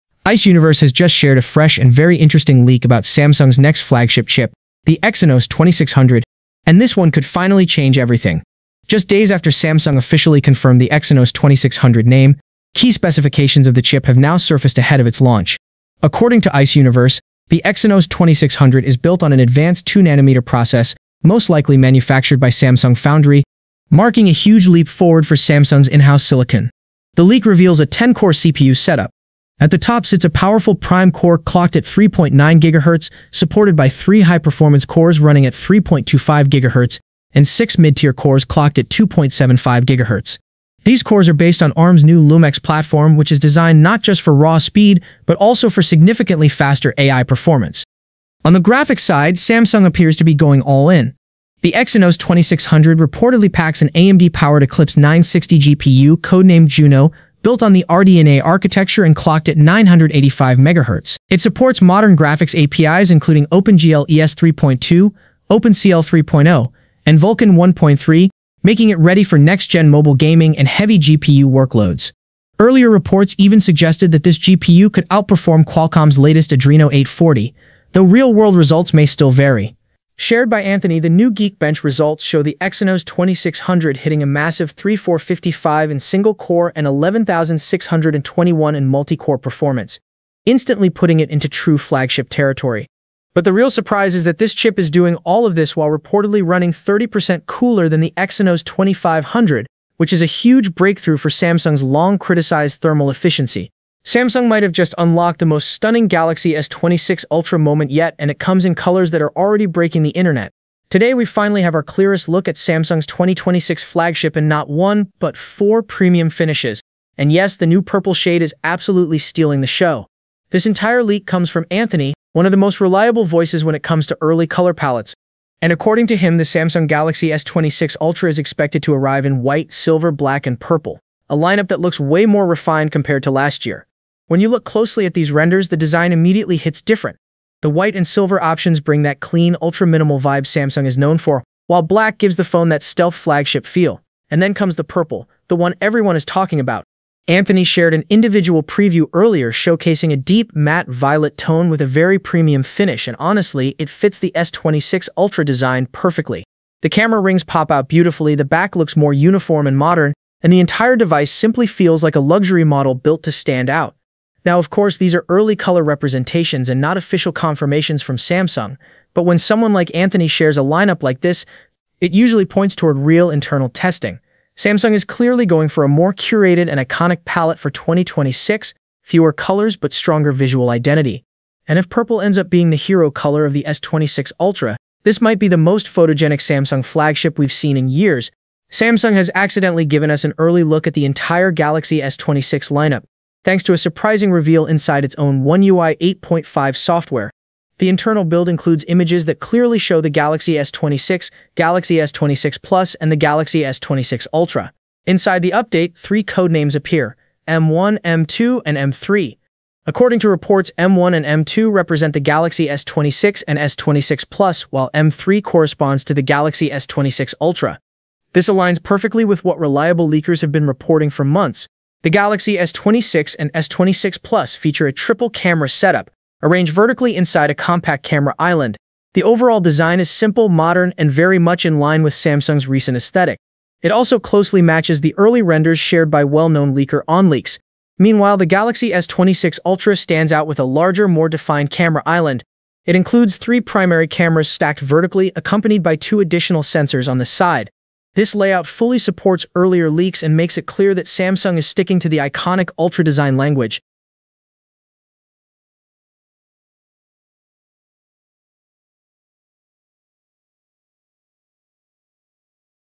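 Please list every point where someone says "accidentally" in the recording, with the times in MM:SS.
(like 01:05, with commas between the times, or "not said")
03:09.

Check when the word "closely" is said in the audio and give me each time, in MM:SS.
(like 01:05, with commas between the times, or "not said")
02:14, 03:54.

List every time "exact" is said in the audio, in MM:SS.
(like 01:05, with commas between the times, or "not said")
not said.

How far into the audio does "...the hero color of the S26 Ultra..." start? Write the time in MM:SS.
03:02.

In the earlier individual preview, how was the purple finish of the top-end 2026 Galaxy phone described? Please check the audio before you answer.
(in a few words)
deep matte violet.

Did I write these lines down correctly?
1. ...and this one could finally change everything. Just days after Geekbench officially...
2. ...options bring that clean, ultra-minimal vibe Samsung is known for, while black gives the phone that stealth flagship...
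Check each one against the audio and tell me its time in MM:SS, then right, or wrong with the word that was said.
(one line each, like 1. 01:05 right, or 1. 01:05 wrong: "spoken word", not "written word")
1. 00:06 wrong: "Samsung", not "Geekbench"
2. 02:18 right.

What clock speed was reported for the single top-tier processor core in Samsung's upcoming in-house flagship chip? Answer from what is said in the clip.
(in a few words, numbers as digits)
3.9 GHz.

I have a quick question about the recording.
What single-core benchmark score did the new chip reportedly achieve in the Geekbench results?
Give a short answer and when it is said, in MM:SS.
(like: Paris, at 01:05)
3455, at 01:24.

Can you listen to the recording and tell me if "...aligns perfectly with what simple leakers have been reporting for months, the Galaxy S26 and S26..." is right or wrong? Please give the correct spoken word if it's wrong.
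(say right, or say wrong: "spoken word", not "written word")
wrong: "reliable", not "simple".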